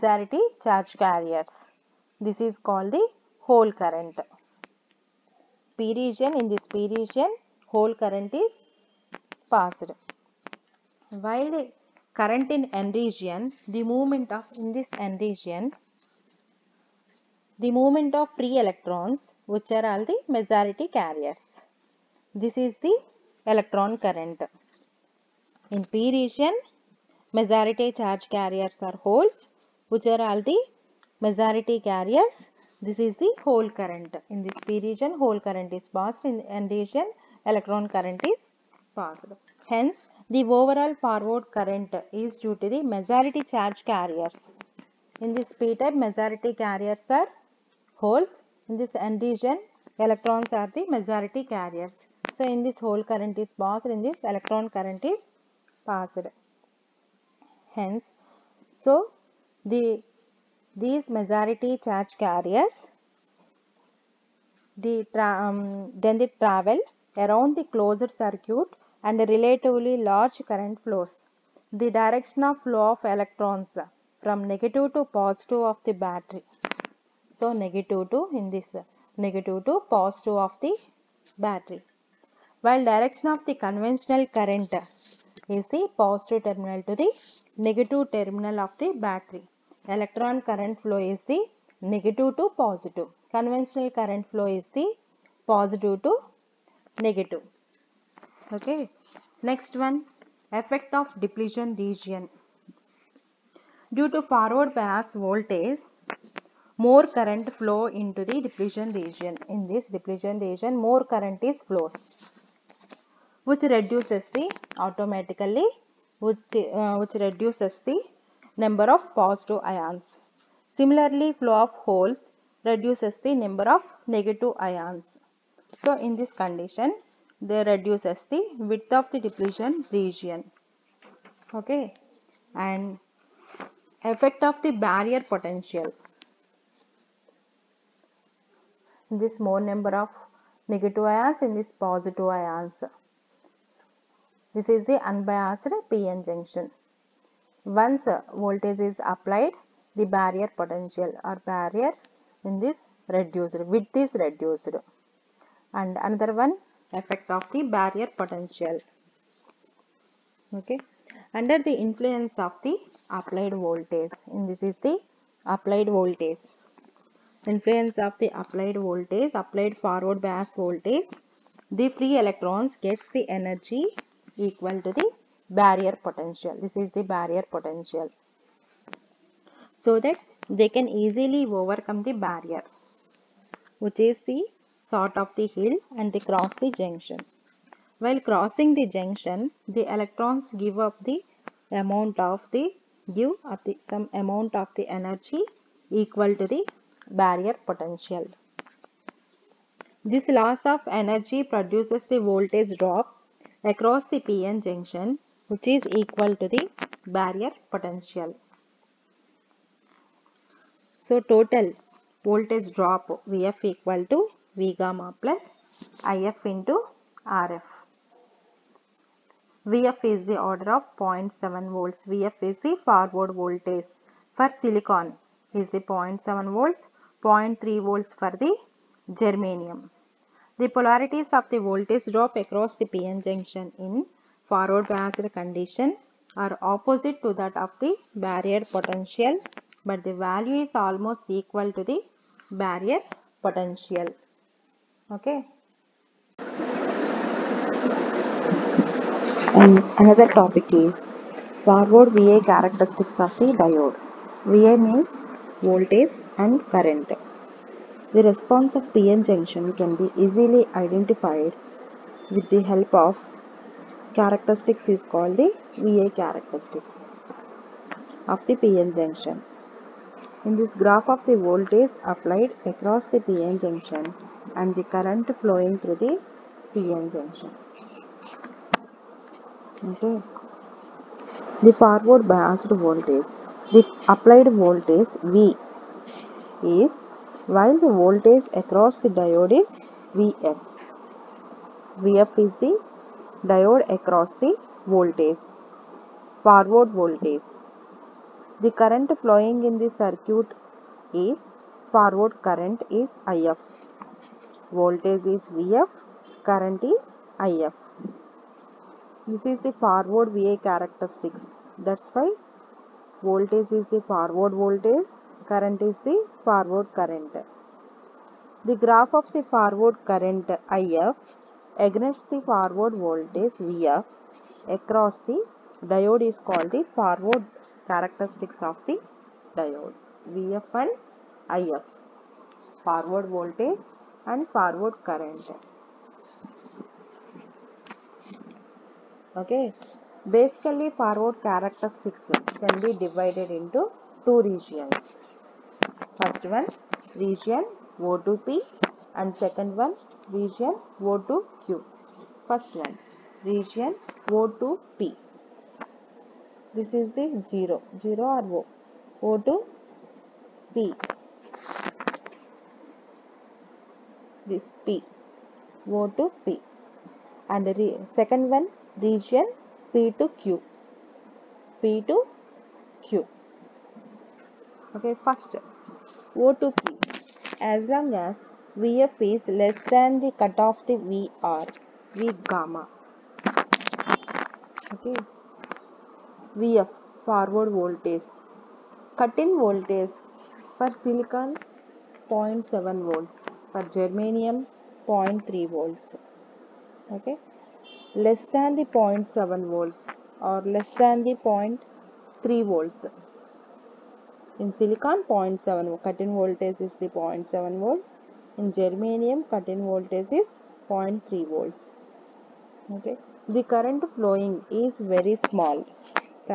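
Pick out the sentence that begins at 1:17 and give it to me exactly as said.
So negative 2 in this negative to positive of the battery.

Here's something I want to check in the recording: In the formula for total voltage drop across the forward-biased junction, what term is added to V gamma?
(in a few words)
If into Rf.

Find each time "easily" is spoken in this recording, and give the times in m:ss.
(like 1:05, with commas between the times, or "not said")
3:00, 4:20.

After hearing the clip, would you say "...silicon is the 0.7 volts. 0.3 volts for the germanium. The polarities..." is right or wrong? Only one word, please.
right.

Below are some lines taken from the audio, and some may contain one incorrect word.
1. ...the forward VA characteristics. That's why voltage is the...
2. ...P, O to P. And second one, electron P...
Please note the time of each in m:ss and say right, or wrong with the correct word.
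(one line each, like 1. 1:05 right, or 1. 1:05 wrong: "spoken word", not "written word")
1. 5:09 right
2. 6:04 wrong: "region", not "electron".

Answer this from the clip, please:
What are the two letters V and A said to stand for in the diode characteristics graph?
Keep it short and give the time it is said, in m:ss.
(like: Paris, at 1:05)
voltage and current, at 4:15.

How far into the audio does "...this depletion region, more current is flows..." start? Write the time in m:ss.
1:49.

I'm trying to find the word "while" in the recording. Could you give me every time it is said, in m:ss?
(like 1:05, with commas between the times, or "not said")
0:11, 1:22, 3:07, 4:47.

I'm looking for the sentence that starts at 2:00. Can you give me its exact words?
Similarly, flow of holes reduces the number of negative ions.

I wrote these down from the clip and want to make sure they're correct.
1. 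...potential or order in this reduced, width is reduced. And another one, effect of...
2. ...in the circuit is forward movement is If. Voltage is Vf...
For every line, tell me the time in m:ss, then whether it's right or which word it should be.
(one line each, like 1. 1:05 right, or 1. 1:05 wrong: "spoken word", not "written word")
1. 2:30 wrong: "barrier", not "order"
2. 4:59 wrong: "current", not "movement".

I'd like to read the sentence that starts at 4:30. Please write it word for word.
In this graph of the voltage applied across the PN junction and the current flowing through the PN junction.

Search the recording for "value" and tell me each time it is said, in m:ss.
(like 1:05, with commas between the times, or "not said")
4:00.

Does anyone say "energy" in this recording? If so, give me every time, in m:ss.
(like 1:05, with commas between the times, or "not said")
2:53, 3:14, 3:20.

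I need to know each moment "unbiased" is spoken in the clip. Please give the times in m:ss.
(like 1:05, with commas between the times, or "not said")
2:25.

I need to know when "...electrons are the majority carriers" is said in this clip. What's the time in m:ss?
0:50.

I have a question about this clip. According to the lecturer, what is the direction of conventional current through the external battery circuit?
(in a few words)
positive to negative.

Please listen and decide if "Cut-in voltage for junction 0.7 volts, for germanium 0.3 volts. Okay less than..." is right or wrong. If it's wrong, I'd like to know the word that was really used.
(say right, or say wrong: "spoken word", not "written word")
wrong: "silicon", not "junction".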